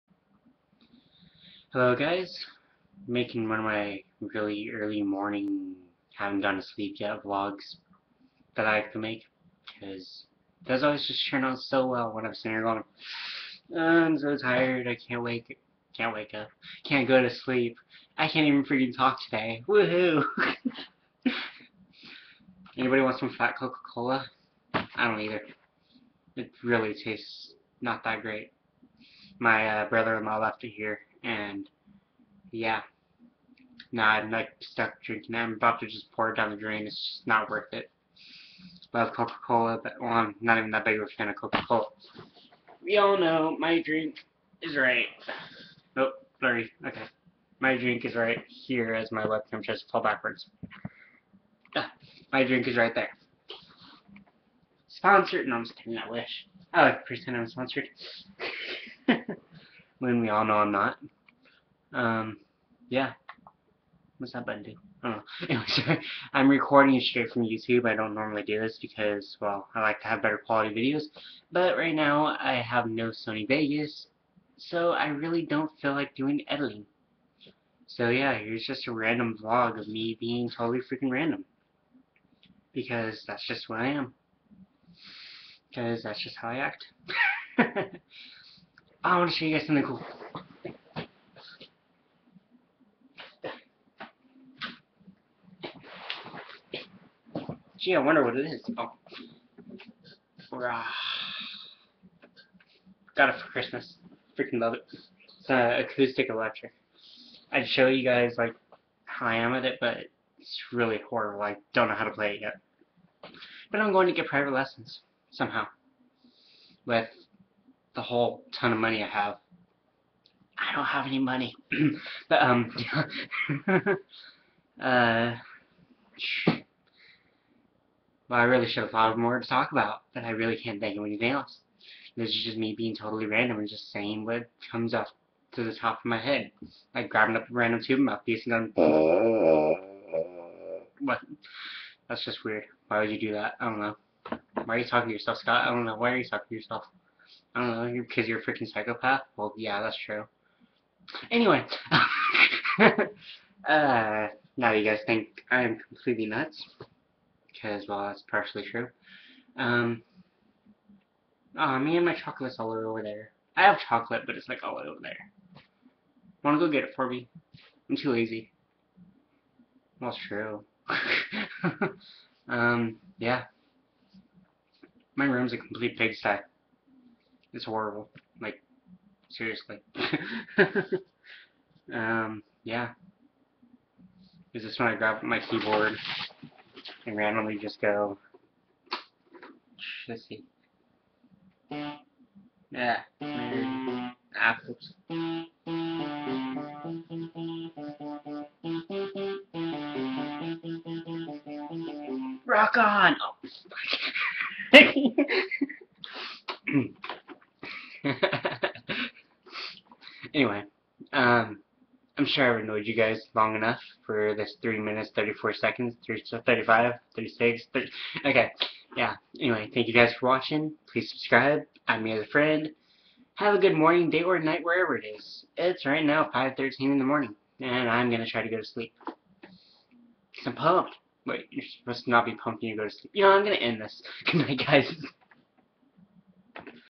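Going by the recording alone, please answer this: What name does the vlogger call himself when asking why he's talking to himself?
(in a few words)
Scott.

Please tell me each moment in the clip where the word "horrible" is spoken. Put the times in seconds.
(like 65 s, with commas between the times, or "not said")
111 s, 177 s.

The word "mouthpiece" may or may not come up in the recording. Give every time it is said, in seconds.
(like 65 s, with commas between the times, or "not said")
137 s.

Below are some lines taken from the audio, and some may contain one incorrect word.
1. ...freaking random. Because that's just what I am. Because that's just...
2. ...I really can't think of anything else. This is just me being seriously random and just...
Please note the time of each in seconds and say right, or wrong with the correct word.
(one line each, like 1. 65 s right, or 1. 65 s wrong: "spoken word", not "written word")
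1. 80 s right
2. 130 s wrong: "totally", not "seriously".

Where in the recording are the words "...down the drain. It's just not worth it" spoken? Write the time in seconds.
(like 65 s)
36 s.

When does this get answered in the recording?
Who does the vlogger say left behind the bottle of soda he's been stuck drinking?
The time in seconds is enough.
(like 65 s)
29 s.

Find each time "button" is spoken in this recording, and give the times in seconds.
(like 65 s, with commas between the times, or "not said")
64 s.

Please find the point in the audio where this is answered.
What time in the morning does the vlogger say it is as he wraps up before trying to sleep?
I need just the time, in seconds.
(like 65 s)
226 s.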